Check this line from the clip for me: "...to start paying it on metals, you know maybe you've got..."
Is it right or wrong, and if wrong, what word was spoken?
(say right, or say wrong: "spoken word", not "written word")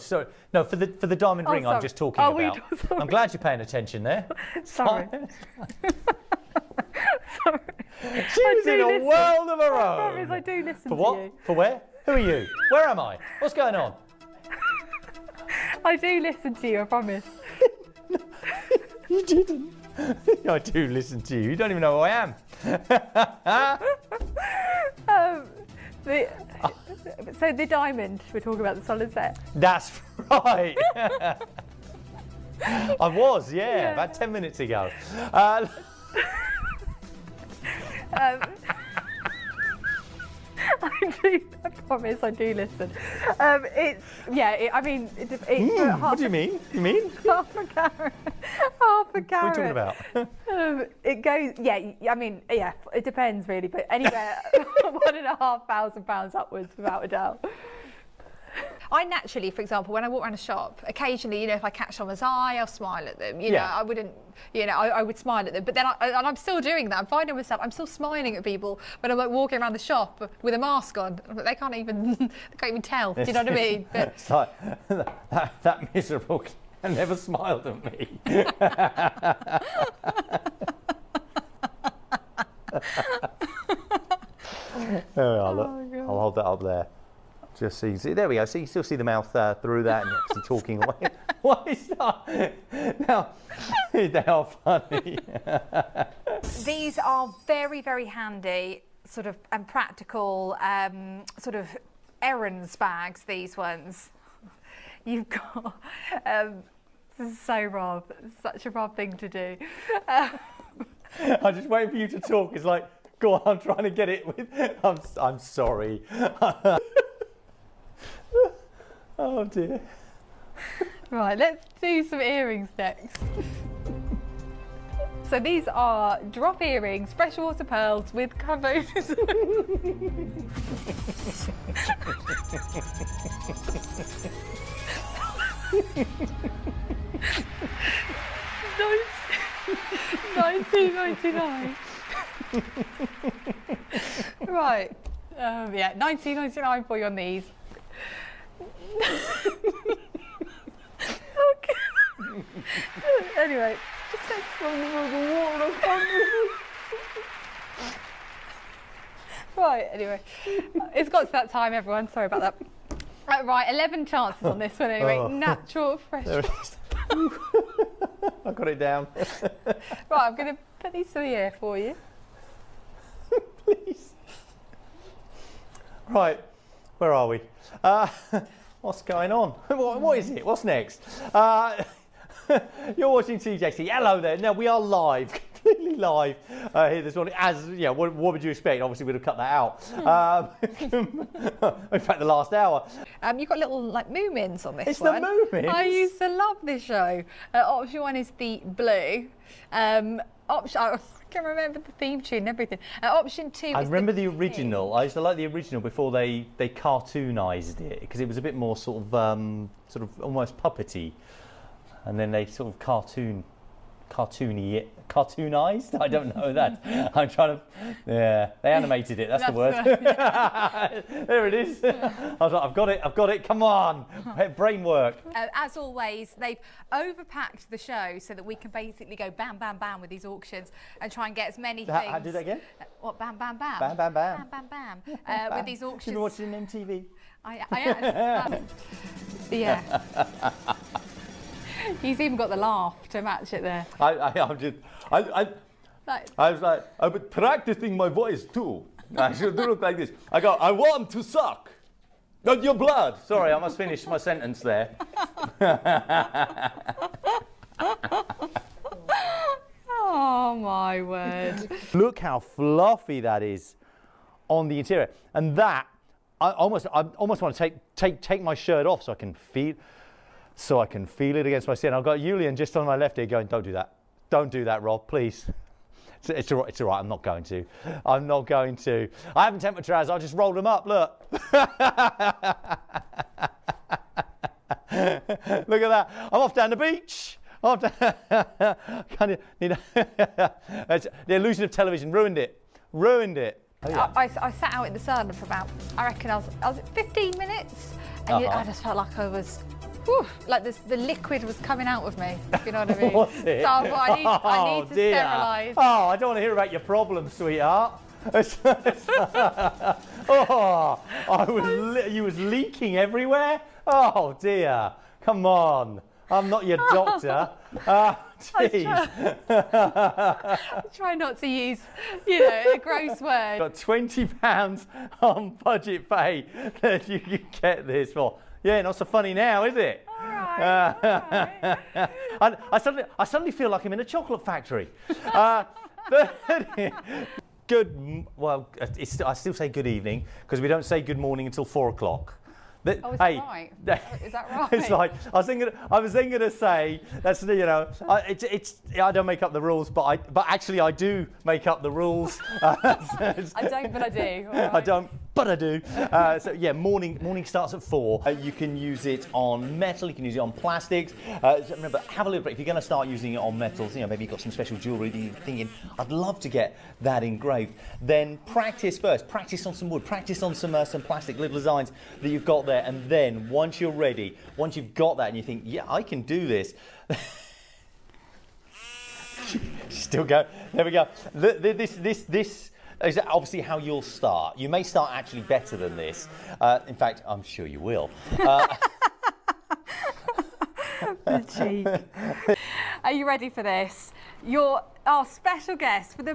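wrong: "using", not "paying".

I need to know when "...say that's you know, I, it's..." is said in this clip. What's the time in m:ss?
5:46.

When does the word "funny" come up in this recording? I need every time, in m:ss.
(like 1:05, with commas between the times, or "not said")
1:34, 5:29.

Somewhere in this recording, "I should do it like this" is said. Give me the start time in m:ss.
4:09.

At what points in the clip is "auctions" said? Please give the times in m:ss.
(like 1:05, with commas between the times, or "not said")
3:50, 3:55.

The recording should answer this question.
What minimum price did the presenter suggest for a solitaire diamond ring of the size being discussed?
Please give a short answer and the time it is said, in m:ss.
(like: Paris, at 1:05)
1,500 pounds, at 0:54.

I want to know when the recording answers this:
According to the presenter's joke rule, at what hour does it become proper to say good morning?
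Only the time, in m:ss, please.
5:41.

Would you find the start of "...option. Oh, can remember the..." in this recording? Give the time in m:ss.
3:20.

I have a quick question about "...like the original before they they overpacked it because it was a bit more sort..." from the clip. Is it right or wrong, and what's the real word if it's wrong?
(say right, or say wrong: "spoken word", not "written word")
wrong: "cartoonised", not "overpacked".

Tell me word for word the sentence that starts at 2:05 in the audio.
so these are drop earrings, freshwater pearls with carbon.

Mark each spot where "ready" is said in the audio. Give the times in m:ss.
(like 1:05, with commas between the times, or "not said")
6:13, 6:33.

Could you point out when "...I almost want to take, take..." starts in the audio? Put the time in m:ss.
4:26.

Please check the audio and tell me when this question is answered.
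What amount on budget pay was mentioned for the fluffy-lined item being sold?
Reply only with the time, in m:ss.
5:23.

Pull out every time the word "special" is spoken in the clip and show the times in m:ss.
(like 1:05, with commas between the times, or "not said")
6:04, 6:35.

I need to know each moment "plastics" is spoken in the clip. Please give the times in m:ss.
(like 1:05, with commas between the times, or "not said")
6:00, 6:11.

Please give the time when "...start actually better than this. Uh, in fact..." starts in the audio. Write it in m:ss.
6:24.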